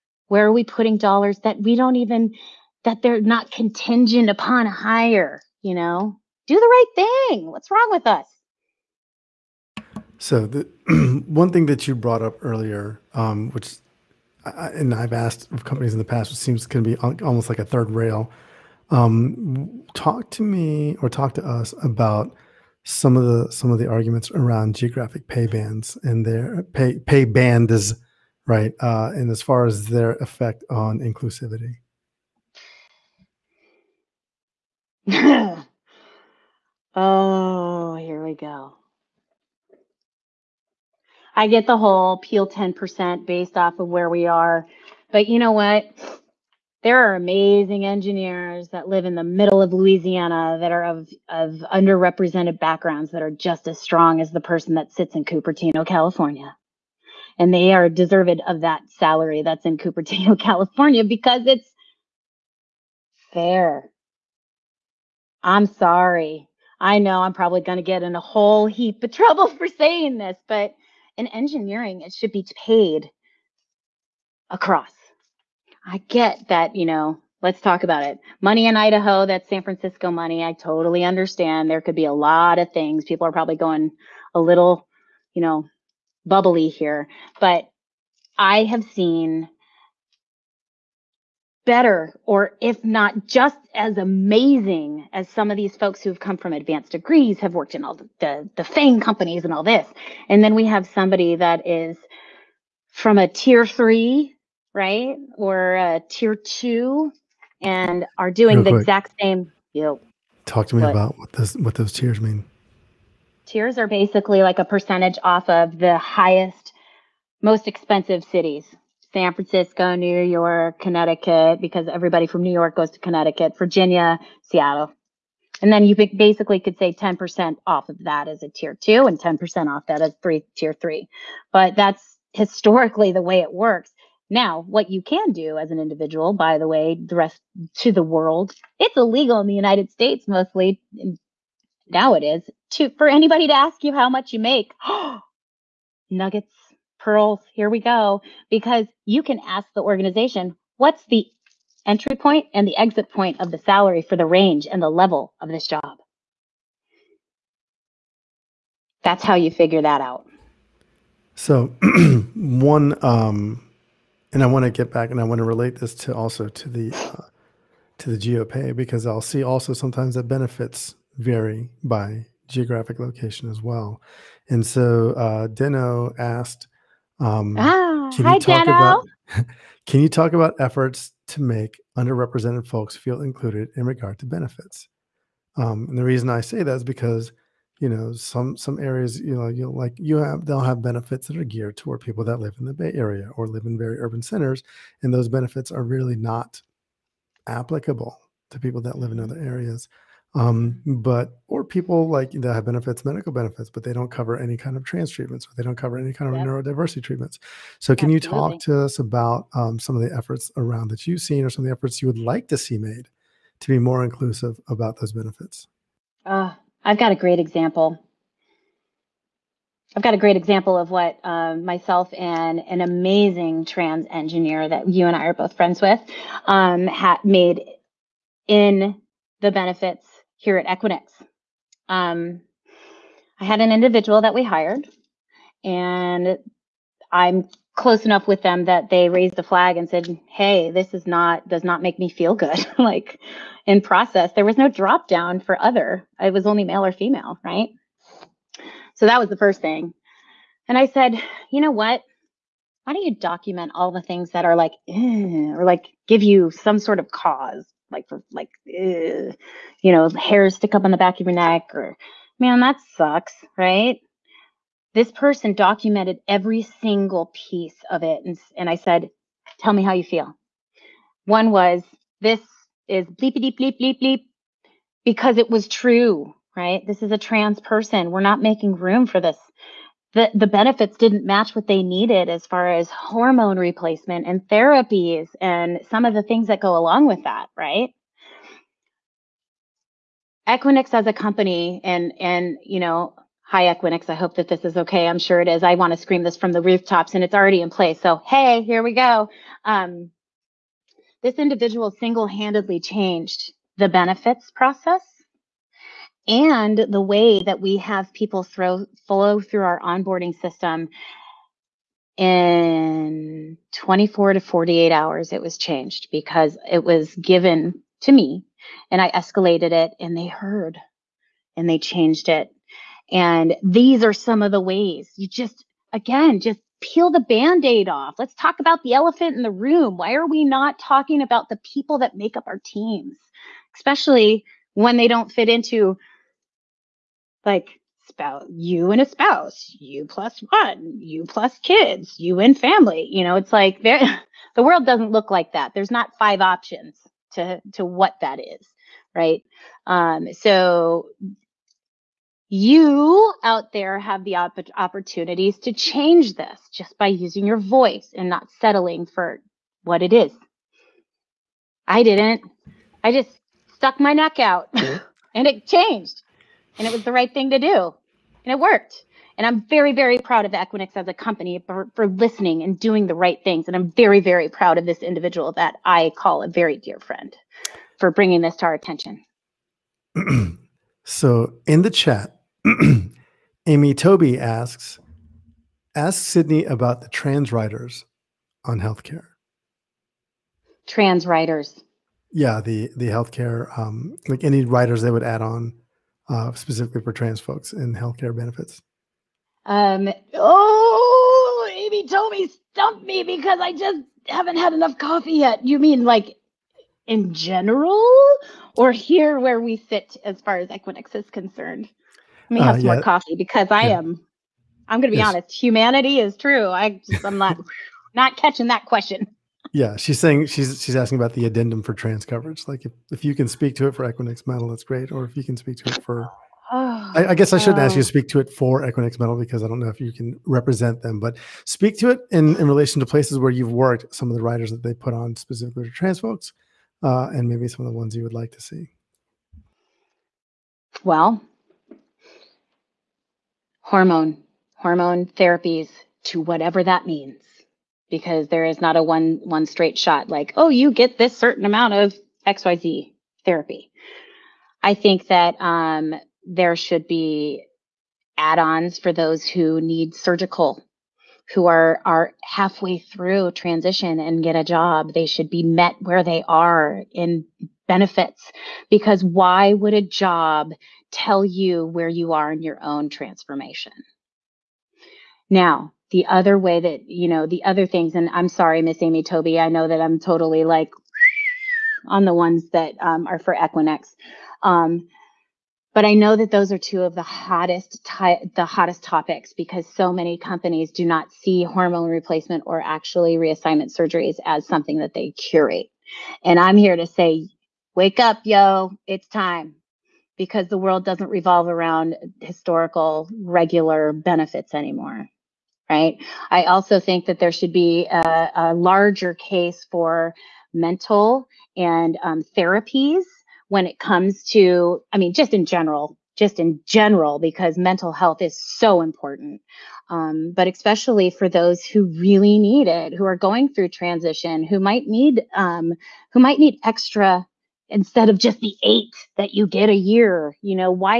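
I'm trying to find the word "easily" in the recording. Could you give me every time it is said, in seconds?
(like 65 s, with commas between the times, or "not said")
not said.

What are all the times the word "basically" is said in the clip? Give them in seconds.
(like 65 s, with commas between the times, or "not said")
113 s, 125 s.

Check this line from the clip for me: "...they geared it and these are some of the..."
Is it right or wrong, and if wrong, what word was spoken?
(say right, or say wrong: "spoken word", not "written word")
wrong: "changed", not "geared".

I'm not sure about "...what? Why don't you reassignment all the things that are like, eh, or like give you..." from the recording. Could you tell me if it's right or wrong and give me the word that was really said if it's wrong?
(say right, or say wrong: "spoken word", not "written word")
wrong: "document", not "reassignment".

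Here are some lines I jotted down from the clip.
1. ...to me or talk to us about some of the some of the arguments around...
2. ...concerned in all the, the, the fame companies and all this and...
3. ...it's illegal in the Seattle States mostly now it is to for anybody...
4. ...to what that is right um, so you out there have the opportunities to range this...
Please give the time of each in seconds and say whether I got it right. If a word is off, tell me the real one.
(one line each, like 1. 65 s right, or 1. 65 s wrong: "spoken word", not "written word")
1. 20 s right
2. 97 s wrong: "worked", not "concerned"
3. 138 s wrong: "United", not "Seattle"
4. 347 s wrong: "change", not "range".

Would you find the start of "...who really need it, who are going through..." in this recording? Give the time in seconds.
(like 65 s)
521 s.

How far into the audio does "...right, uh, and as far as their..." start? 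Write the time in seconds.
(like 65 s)
28 s.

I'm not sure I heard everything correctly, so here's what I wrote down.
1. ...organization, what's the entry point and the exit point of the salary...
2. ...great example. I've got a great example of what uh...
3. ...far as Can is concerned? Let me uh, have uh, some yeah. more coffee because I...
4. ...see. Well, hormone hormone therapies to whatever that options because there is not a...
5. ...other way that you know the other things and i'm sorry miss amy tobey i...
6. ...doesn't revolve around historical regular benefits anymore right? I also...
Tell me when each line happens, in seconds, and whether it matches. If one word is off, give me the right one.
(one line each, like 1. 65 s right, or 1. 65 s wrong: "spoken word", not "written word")
1. 149 s right
2. 217 s right
3. 410 s wrong: "Equinix", not "Can"
4. 438 s wrong: "means", not "options"
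5. 476 s right
6. 501 s right.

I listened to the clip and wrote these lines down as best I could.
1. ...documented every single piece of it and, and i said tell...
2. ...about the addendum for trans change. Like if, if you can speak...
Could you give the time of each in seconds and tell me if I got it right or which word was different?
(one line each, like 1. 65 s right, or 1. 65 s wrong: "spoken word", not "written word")
1. 265 s right
2. 421 s wrong: "coverage", not "change".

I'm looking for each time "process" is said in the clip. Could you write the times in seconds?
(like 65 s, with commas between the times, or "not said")
243 s, 304 s.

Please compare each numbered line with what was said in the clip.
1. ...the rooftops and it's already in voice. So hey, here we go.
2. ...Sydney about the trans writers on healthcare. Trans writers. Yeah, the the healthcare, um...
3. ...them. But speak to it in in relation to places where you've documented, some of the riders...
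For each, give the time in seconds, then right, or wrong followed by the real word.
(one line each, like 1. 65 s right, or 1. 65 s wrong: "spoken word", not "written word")
1. 296 s wrong: "place", not "voice"
2. 386 s right
3. 430 s wrong: "worked", not "documented".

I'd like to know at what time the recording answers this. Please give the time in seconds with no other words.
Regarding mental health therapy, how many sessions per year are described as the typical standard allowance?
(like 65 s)
528 s.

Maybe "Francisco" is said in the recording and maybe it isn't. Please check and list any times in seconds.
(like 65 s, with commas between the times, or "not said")
79 s, 119 s.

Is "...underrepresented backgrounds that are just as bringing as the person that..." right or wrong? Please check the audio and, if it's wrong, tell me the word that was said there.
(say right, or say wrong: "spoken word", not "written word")
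wrong: "strong", not "bringing".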